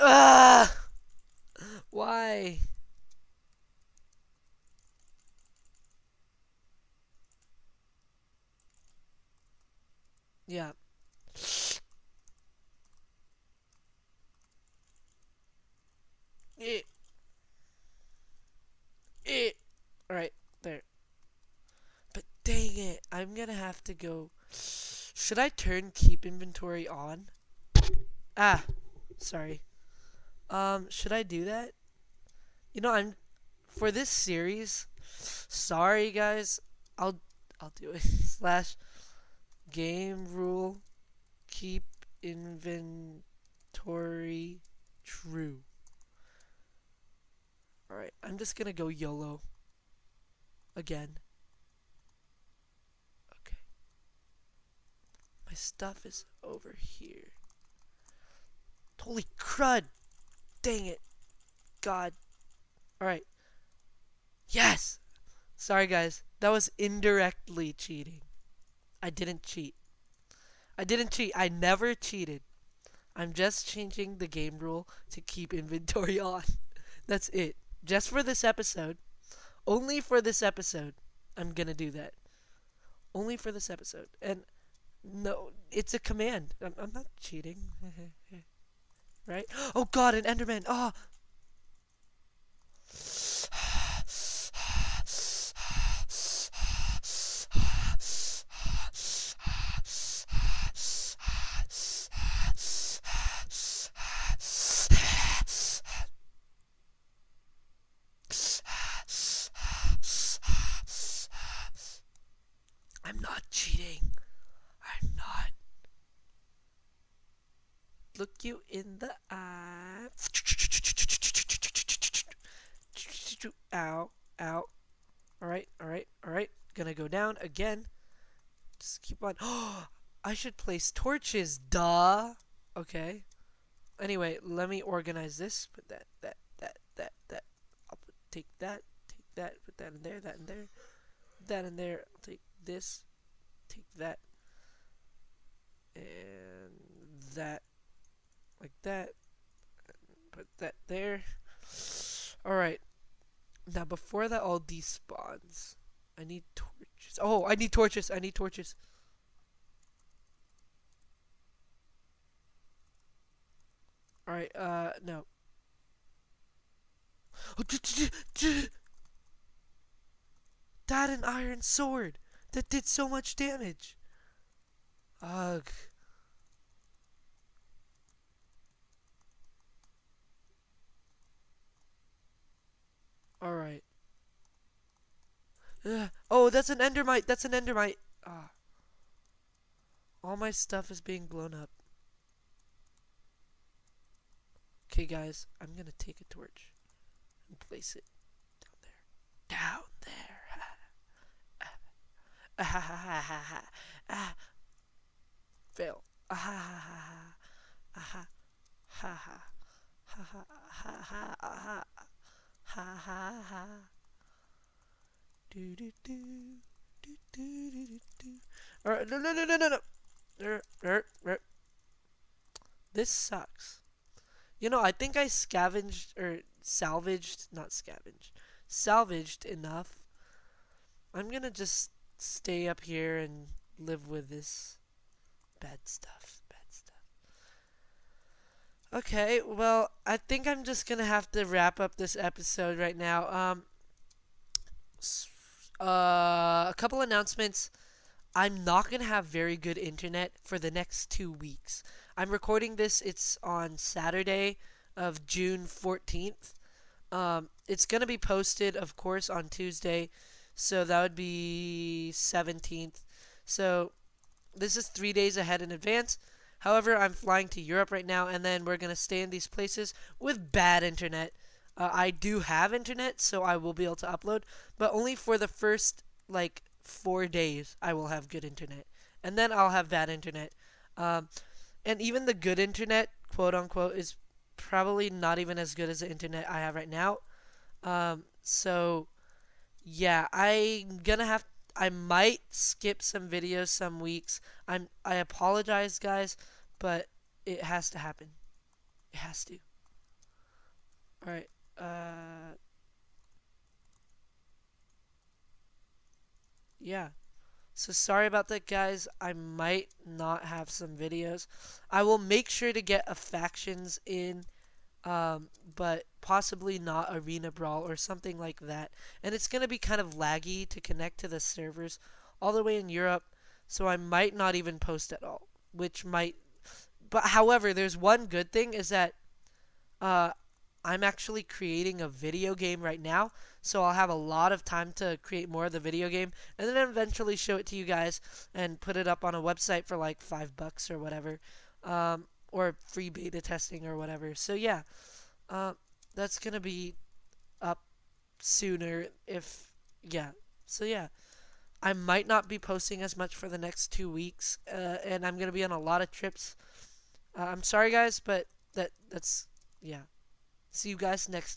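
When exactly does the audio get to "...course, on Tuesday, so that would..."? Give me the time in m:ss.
4:18.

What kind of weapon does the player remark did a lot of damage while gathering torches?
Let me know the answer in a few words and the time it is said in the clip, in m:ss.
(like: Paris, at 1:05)
iron sword, at 2:51.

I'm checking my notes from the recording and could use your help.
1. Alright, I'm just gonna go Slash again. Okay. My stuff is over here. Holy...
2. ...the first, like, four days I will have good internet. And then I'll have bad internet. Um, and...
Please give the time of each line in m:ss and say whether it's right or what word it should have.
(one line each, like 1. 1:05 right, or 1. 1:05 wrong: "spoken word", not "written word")
1. 0:47 wrong: "YOLO", not "Slash"
2. 4:35 right.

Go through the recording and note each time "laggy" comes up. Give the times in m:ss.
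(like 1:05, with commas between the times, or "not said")
5:20.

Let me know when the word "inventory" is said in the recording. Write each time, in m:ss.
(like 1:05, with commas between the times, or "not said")
0:26, 0:42, 1:15.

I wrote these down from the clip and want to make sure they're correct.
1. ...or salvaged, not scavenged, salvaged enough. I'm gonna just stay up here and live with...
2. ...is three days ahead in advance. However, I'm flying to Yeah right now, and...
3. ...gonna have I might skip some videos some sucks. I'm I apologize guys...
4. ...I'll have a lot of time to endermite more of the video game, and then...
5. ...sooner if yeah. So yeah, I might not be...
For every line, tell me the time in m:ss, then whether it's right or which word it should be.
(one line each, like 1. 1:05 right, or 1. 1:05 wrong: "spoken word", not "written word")
1. 3:46 right
2. 4:24 wrong: "Europe", not "Yeah"
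3. 4:51 wrong: "weeks", not "sucks"
4. 5:33 wrong: "create", not "endermite"
5. 5:48 right.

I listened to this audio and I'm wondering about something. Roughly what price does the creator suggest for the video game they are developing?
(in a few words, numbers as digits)
$5.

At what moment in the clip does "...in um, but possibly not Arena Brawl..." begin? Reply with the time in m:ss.
5:14.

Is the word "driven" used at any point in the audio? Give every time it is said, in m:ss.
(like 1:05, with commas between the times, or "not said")
not said.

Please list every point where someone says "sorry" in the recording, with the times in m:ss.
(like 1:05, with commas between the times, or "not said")
0:29, 0:35, 1:05, 5:07, 5:57.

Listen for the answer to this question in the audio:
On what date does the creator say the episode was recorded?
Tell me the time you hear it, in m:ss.
4:15.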